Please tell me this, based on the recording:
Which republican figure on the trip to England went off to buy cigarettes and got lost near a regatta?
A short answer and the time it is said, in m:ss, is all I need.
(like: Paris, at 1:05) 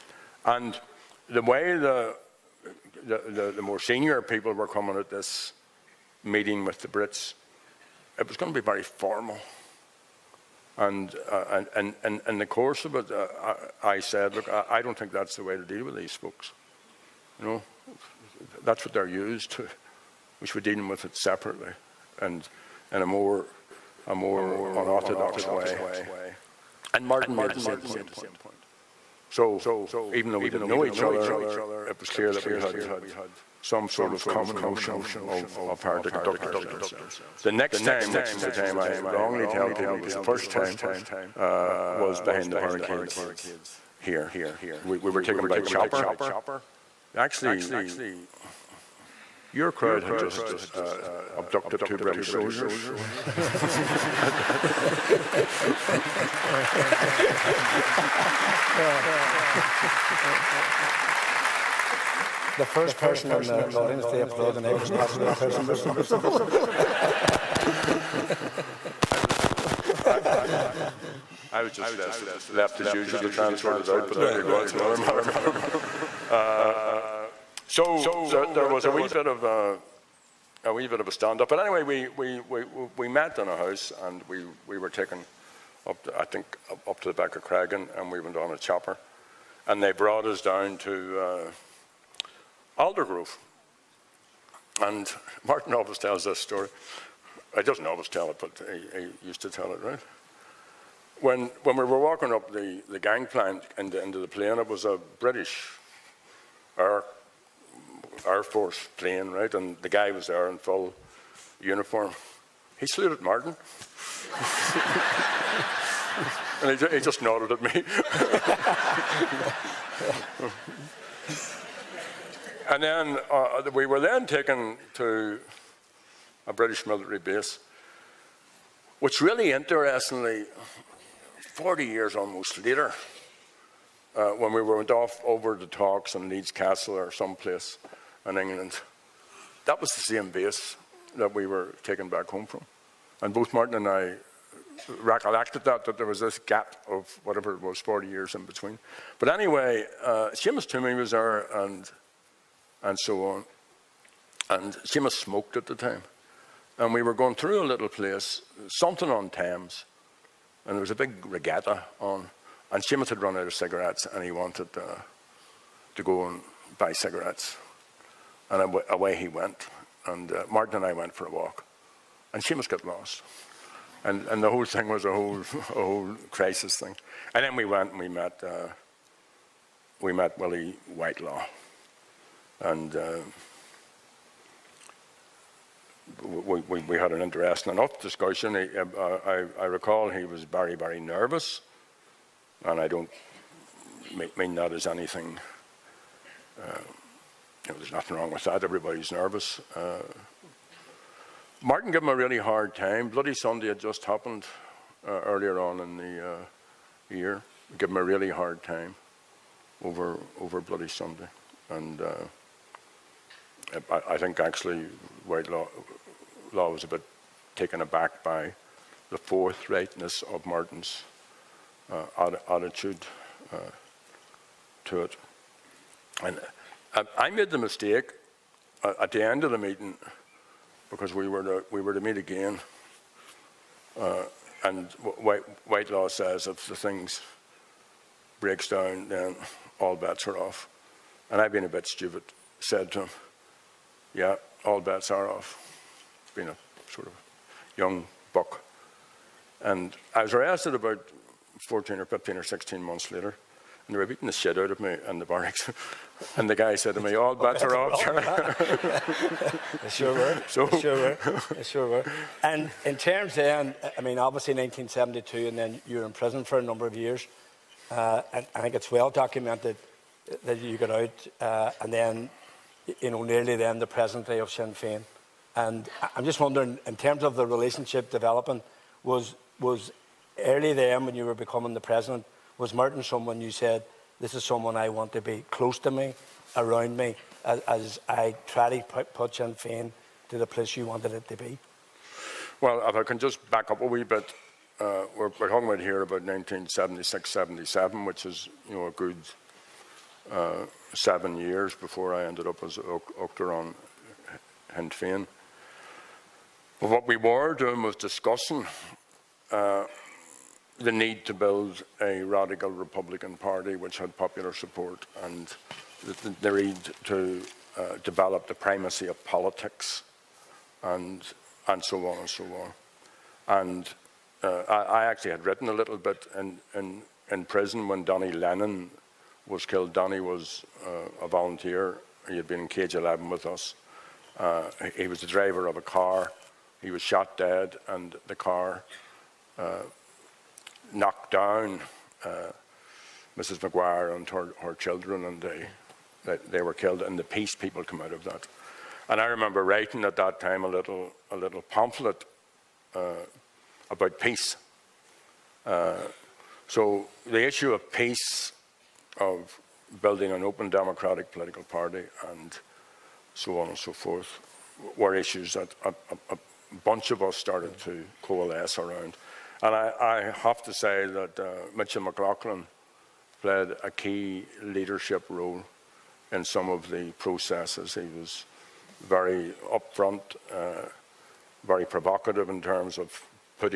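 Seamus Twomey, at 2:30.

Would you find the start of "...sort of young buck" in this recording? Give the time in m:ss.
4:06.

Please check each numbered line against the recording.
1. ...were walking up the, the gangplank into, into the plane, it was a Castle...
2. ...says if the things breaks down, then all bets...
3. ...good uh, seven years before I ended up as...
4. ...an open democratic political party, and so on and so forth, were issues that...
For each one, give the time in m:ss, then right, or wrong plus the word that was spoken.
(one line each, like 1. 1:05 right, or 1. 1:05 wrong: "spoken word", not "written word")
1. 1:41 wrong: "British", not "Castle"
2. 3:56 right
3. 4:58 right
4. 6:00 right.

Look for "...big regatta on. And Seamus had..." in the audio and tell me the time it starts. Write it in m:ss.
2:40.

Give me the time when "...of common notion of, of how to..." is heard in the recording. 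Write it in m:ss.
0:34.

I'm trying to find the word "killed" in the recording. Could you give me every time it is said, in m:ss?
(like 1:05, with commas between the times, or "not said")
5:29, 5:46.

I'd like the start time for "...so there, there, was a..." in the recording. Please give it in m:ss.
1:17.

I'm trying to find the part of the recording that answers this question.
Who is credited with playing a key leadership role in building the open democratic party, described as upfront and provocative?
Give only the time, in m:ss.
6:11.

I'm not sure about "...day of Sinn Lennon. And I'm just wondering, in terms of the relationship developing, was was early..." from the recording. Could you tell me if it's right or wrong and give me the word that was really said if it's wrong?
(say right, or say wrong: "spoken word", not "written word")
wrong: "Féin", not "Lennon".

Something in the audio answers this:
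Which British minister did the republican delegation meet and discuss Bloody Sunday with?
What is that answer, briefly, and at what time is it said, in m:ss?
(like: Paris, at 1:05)
Willie Whitelaw, at 3:00.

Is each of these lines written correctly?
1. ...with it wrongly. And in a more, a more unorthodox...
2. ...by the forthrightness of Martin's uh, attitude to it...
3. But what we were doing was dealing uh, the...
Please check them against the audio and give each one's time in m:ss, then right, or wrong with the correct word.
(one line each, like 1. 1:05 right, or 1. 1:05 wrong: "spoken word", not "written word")
1. 0:20 wrong: "separately", not "wrongly"
2. 3:38 right
3. 5:06 wrong: "discussing", not "dealing".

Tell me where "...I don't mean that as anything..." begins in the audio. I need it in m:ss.
3:12.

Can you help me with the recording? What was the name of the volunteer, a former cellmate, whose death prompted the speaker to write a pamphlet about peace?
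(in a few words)
Danny Lennon.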